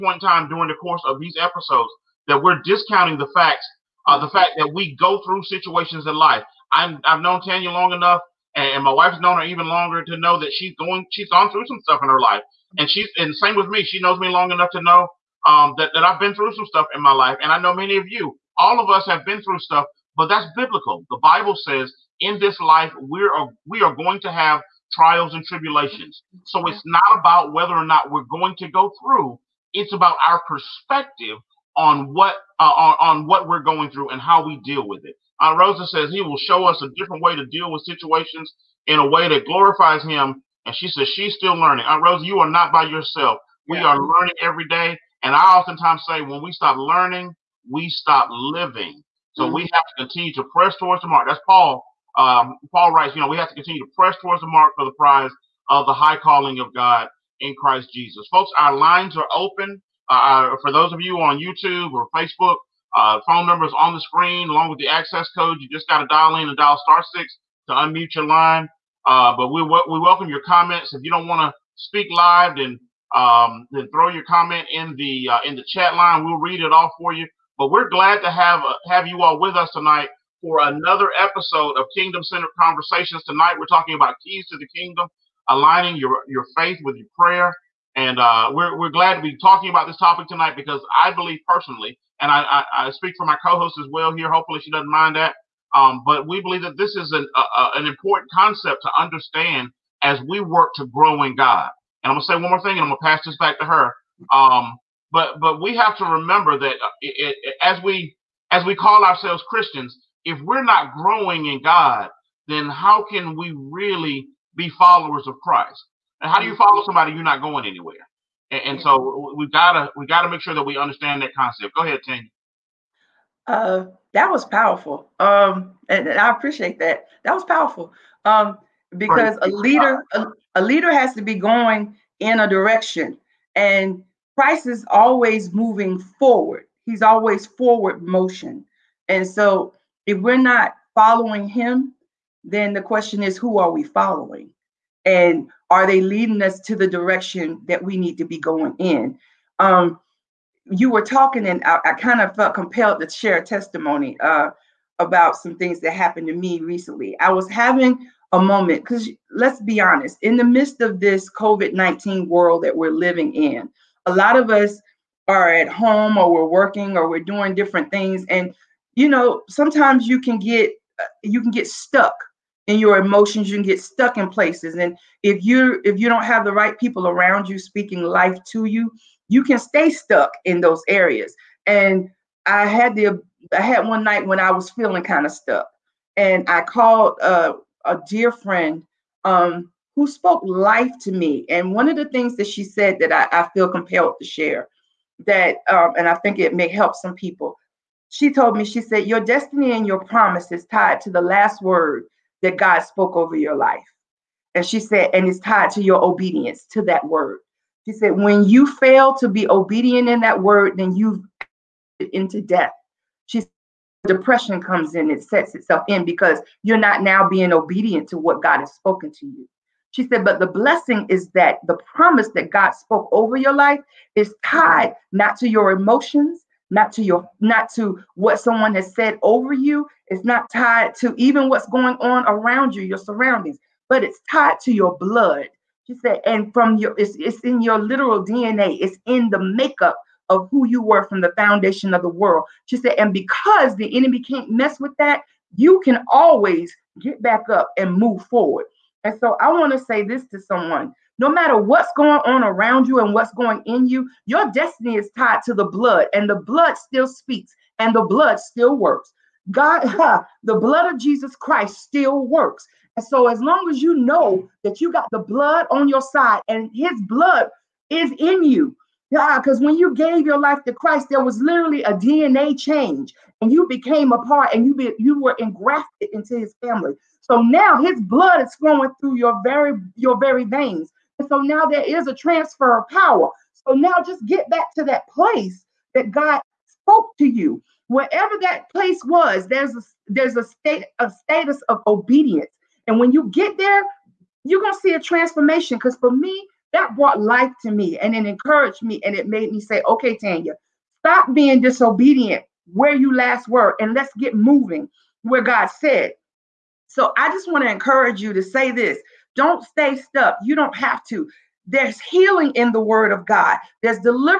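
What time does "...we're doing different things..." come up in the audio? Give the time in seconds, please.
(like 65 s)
167 s.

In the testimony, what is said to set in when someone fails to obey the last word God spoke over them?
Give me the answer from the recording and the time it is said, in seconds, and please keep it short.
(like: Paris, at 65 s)
depression, at 214 s.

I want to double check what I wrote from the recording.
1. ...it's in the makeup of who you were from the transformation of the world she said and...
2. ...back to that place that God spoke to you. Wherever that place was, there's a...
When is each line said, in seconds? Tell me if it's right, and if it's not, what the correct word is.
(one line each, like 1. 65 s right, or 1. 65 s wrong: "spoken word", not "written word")
1. 238 s wrong: "foundation", not "transformation"
2. 284 s right.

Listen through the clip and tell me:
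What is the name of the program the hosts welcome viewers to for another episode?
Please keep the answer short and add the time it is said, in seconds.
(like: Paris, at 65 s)
Kingdom Centered Konversations, at 81 s.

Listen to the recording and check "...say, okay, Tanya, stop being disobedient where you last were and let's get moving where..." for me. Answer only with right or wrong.
right.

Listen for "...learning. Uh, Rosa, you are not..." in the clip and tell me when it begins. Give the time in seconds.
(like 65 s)
41 s.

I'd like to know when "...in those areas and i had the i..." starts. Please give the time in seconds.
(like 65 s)
180 s.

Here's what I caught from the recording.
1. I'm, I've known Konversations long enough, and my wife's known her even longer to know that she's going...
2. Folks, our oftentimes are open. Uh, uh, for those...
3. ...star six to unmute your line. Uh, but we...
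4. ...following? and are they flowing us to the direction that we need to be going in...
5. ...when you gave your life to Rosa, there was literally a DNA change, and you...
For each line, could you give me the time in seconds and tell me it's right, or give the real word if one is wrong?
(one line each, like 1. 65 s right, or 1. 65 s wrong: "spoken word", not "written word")
1. 6 s wrong: "Tanya", not "Konversations"
2. 58 s wrong: "lines", not "oftentimes"
3. 66 s right
4. 143 s wrong: "leading", not "flowing"
5. 269 s wrong: "Christ", not "Rosa".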